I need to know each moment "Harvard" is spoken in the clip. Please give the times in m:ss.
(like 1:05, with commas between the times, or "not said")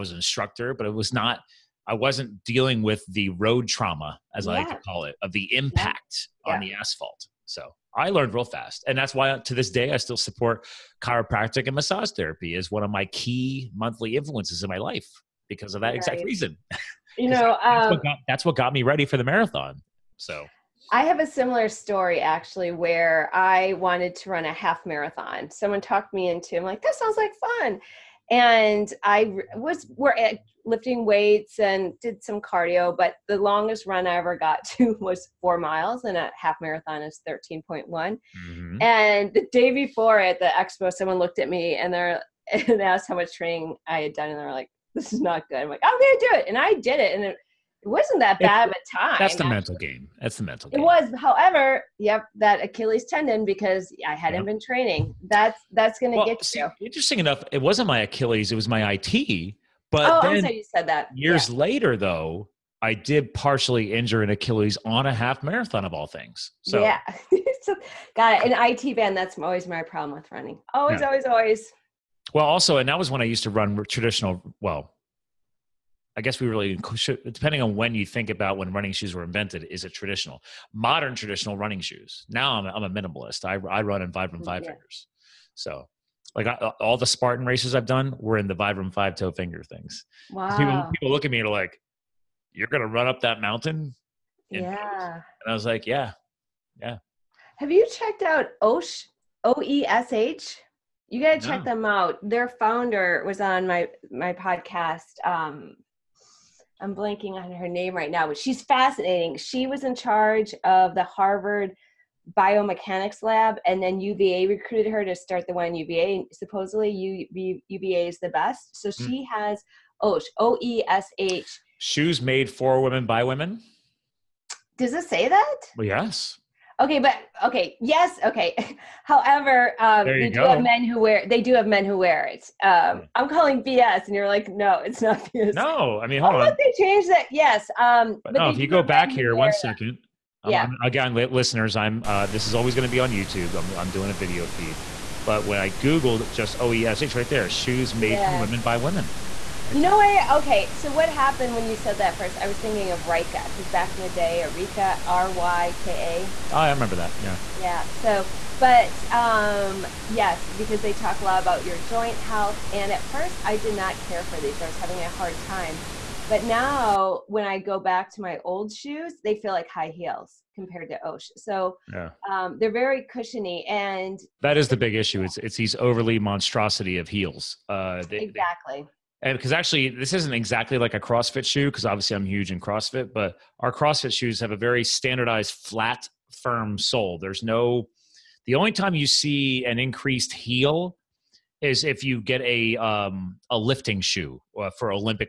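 1:51.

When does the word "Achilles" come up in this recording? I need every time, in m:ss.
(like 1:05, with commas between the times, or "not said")
0:52, 0:58, 1:04.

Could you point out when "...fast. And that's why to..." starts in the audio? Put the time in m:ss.
0:08.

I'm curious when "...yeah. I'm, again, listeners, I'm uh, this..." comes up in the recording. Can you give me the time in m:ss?
2:20.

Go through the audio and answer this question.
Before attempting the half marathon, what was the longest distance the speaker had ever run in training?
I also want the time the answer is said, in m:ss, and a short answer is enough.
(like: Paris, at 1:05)
4 miles, at 0:35.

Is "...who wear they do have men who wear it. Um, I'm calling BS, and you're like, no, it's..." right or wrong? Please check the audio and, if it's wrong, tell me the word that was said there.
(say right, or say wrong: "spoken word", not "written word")
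right.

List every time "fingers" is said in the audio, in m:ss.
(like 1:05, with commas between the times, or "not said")
1:24, 1:29.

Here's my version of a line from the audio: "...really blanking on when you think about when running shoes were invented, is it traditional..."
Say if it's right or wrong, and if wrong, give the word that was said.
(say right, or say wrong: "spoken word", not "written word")
wrong: "depending", not "blanking".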